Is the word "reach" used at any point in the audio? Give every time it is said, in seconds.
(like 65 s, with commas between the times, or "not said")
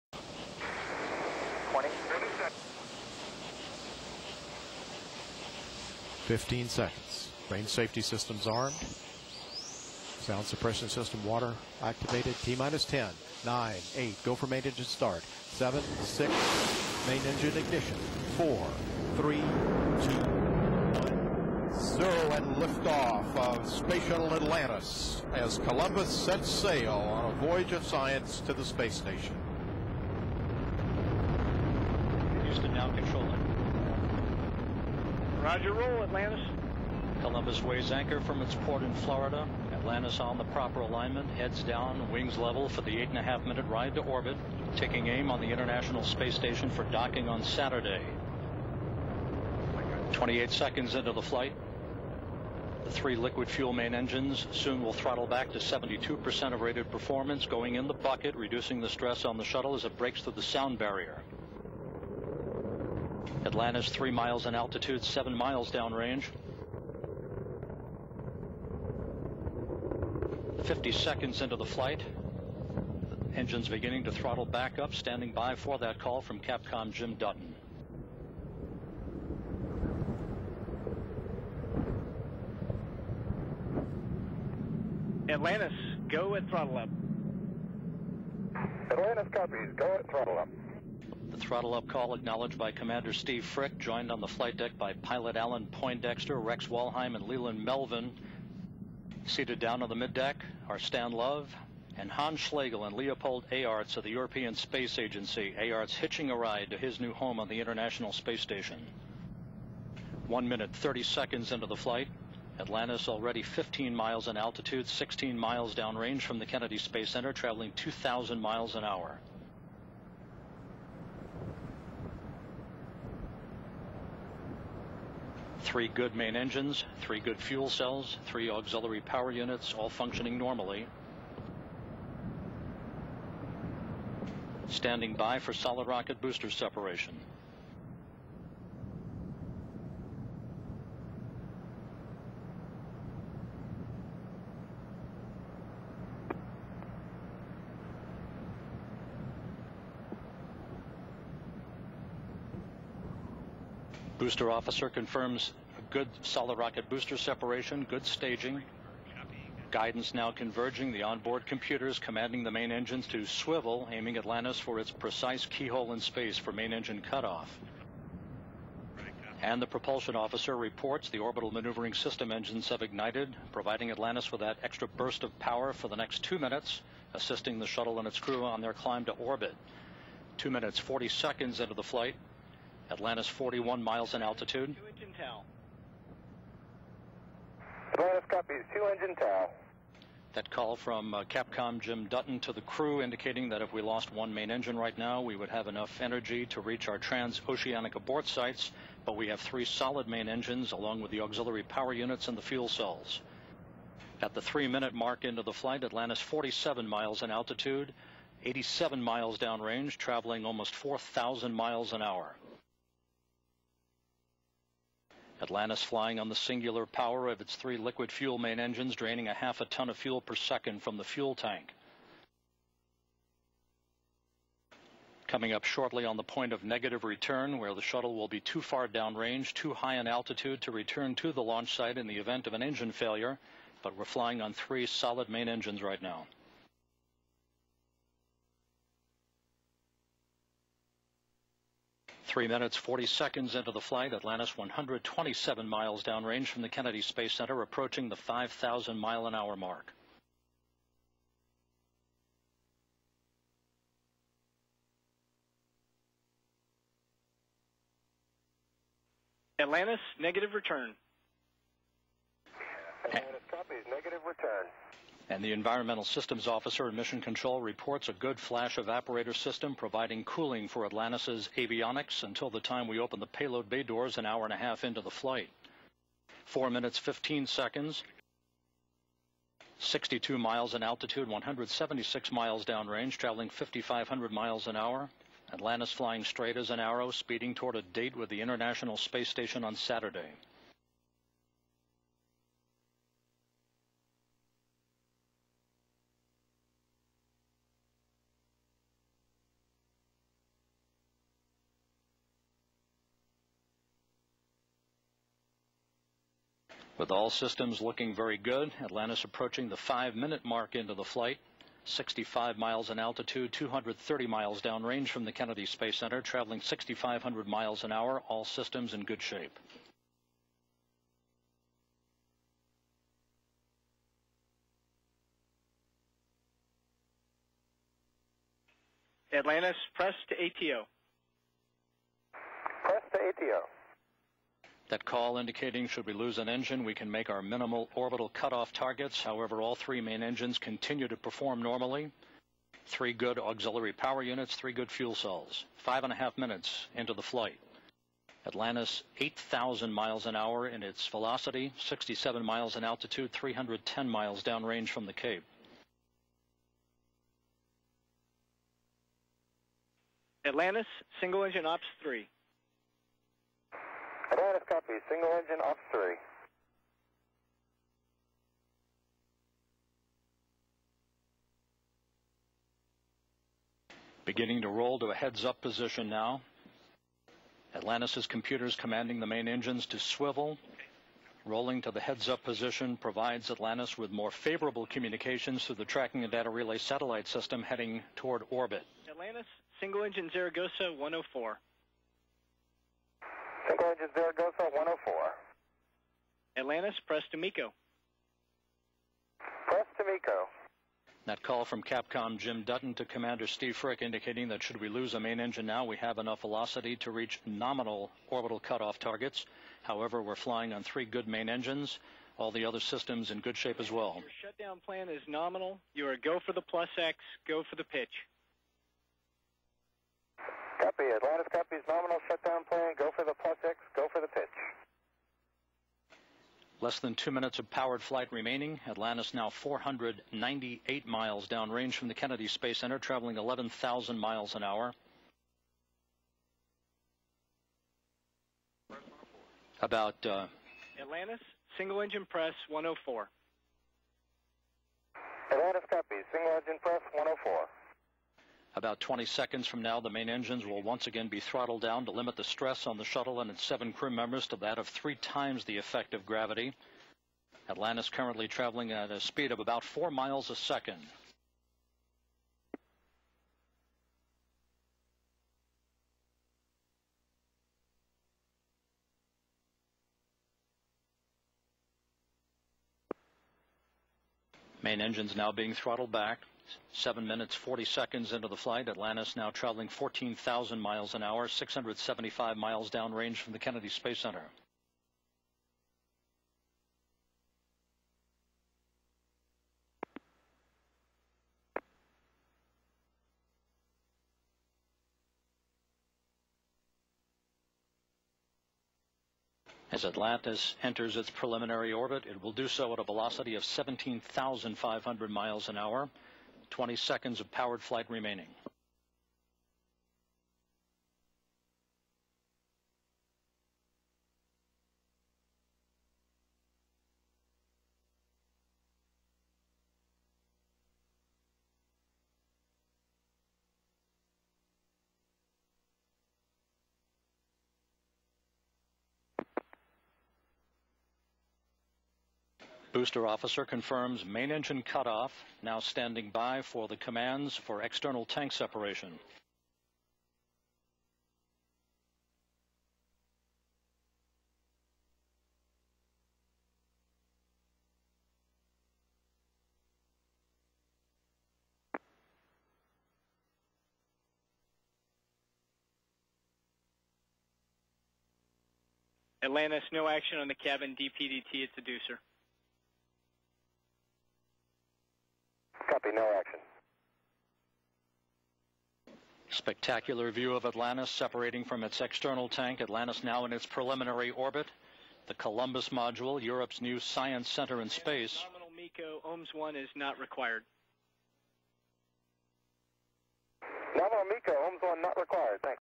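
196 s, 407 s.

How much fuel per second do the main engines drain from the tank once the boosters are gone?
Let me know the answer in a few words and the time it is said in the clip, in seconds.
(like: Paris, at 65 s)
Half a ton, at 219 s.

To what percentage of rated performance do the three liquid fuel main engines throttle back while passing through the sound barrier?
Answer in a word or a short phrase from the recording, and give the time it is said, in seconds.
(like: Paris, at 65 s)
72%, at 55 s.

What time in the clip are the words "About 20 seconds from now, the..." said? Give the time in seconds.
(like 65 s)
448 s.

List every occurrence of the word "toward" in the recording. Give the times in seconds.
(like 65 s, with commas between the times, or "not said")
287 s, 388 s.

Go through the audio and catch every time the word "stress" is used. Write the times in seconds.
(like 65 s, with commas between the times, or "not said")
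58 s, 452 s.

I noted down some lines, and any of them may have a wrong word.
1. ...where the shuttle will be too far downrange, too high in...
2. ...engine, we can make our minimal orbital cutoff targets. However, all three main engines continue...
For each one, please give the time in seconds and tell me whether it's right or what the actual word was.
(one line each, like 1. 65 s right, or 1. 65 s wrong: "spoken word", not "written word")
1. 227 s right
2. 336 s right.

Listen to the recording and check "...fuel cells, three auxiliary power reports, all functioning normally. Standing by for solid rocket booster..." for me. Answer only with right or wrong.
wrong.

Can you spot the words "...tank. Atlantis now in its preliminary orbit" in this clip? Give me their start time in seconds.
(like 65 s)
572 s.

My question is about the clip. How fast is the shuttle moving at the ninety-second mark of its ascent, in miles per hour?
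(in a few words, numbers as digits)
2,000.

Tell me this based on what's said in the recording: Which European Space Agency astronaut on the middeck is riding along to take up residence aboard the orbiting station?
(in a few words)
Leopold Eyharts.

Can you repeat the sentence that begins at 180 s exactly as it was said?
Two minutes, 40 seconds into the flight, Atlantis 41 miles in altitude.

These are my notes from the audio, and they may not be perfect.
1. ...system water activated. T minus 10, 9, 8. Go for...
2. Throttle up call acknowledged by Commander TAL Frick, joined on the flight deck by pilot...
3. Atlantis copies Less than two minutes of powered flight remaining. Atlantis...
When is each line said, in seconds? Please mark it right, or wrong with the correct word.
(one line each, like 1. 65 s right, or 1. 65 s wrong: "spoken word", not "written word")
1. 10 s right
2. 91 s wrong: "Steve", not "TAL"
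3. 421 s right.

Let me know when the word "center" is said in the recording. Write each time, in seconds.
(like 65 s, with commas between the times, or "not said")
117 s, 247 s, 315 s, 432 s, 484 s, 577 s.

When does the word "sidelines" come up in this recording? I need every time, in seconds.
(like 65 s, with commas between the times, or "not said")
not said.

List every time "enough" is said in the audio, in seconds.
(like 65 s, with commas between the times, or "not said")
195 s, 406 s.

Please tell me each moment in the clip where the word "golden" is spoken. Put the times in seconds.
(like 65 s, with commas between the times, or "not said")
not said.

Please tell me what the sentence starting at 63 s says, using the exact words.
Atlantis three miles in altitude, seven miles downrange.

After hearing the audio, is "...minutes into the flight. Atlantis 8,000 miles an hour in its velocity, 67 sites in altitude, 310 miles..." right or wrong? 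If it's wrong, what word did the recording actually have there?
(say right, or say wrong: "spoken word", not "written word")
wrong: "miles", not "sites".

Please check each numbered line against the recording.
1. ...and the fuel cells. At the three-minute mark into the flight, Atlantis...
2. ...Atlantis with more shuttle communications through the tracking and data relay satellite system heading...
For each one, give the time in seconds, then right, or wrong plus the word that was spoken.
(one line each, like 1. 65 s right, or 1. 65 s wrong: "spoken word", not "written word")
1. 202 s right
2. 383 s wrong: "favorable", not "shuttle".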